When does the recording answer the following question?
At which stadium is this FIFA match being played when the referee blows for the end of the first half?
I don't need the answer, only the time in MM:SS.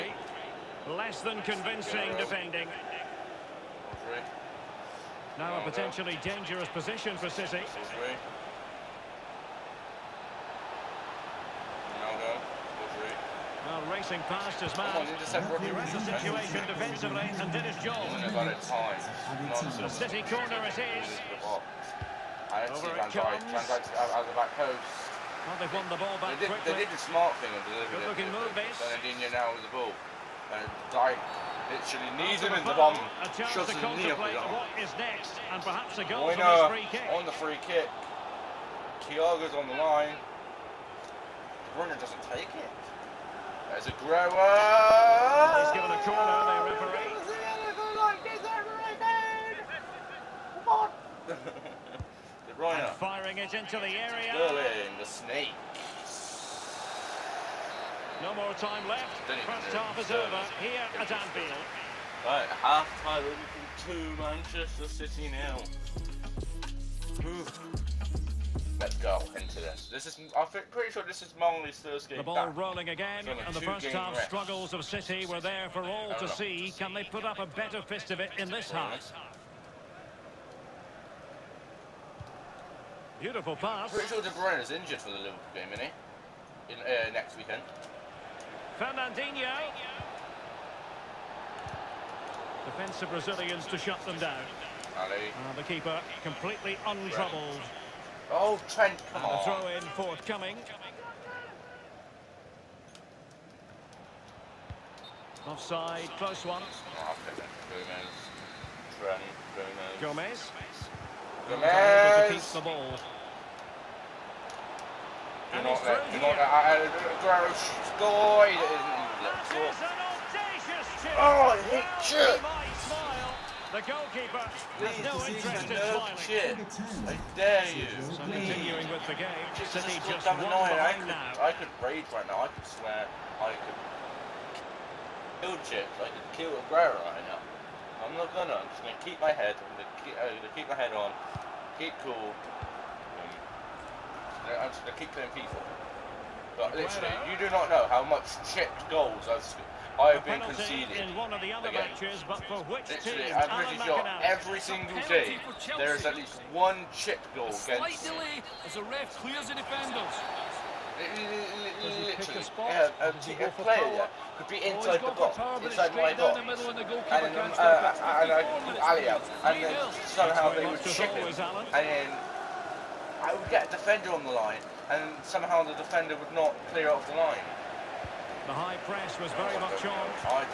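01:01.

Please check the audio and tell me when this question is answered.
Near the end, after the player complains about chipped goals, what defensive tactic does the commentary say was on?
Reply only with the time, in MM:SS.
02:58.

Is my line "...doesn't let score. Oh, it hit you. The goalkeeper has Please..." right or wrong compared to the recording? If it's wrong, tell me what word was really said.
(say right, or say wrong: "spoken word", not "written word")
right.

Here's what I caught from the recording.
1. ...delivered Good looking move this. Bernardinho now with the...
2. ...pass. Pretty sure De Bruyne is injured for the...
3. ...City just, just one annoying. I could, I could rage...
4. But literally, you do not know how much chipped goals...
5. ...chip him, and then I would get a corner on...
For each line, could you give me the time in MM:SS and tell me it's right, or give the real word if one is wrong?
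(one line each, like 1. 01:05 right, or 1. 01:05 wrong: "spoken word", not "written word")
1. 00:27 right
2. 01:23 right
3. 02:09 right
4. 02:26 right
5. 02:50 wrong: "defender", not "corner".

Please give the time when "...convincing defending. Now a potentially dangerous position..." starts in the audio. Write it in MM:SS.
00:01.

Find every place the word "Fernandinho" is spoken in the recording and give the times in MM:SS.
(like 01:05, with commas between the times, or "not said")
01:28.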